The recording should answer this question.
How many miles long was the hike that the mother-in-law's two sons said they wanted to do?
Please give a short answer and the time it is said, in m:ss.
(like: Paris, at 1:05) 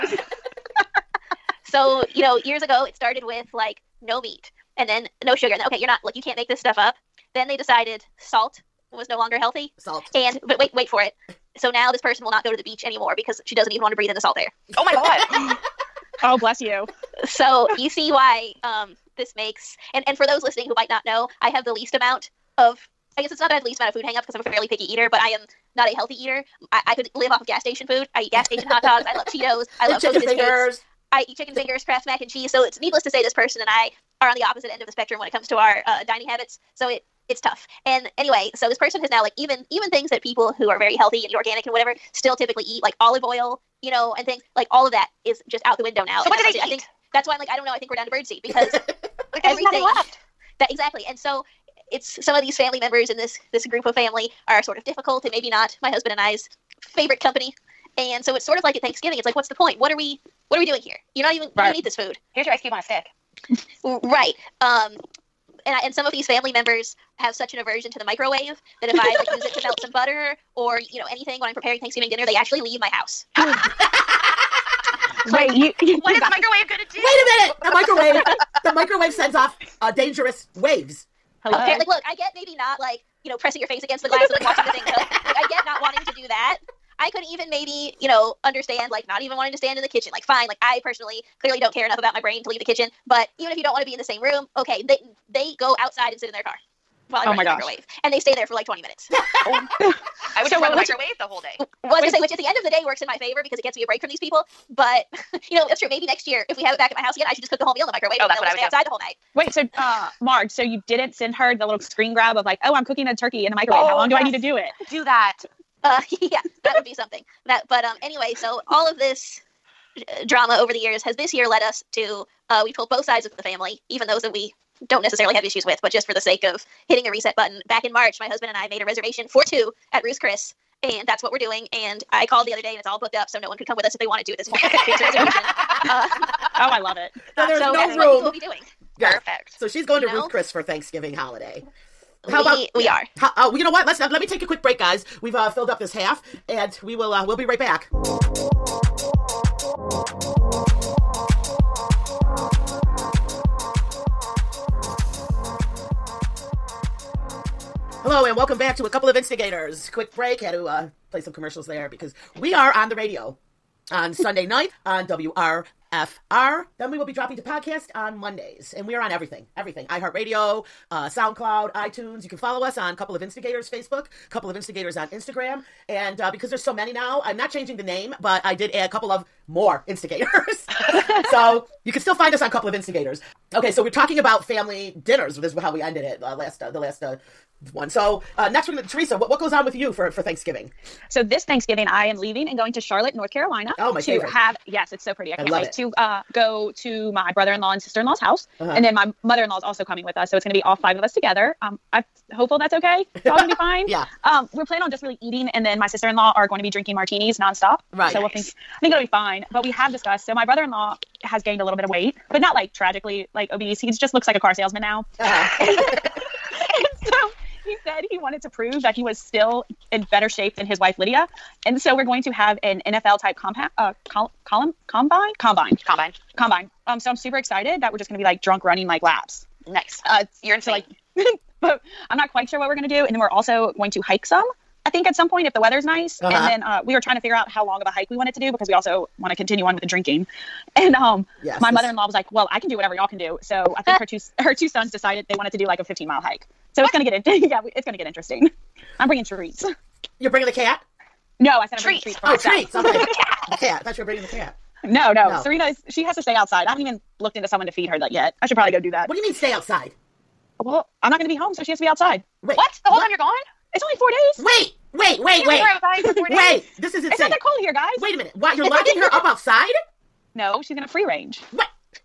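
15, at 4:05.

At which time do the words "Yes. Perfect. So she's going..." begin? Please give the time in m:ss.
2:18.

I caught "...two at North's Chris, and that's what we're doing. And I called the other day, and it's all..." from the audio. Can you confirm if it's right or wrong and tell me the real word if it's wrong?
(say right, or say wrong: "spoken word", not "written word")
wrong: "Ruth", not "North".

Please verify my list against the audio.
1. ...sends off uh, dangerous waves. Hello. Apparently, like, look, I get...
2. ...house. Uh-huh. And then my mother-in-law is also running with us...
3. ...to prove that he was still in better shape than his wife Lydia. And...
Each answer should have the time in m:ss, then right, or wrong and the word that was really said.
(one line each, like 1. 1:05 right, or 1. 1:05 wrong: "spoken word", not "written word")
1. 1:19 right
2. 3:18 wrong: "coming", not "running"
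3. 3:38 right.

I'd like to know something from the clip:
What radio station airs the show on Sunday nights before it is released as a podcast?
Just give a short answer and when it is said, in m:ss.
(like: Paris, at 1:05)
WRFR, at 2:45.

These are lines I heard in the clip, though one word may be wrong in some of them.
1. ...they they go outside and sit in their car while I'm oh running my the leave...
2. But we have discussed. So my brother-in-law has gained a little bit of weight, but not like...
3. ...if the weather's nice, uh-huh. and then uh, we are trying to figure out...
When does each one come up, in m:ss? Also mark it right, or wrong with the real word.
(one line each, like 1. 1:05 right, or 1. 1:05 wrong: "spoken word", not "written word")
1. 1:34 wrong: "microwave", not "leave"
2. 3:29 right
3. 3:55 right.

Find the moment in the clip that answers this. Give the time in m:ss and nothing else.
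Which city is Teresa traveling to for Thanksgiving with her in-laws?
3:12.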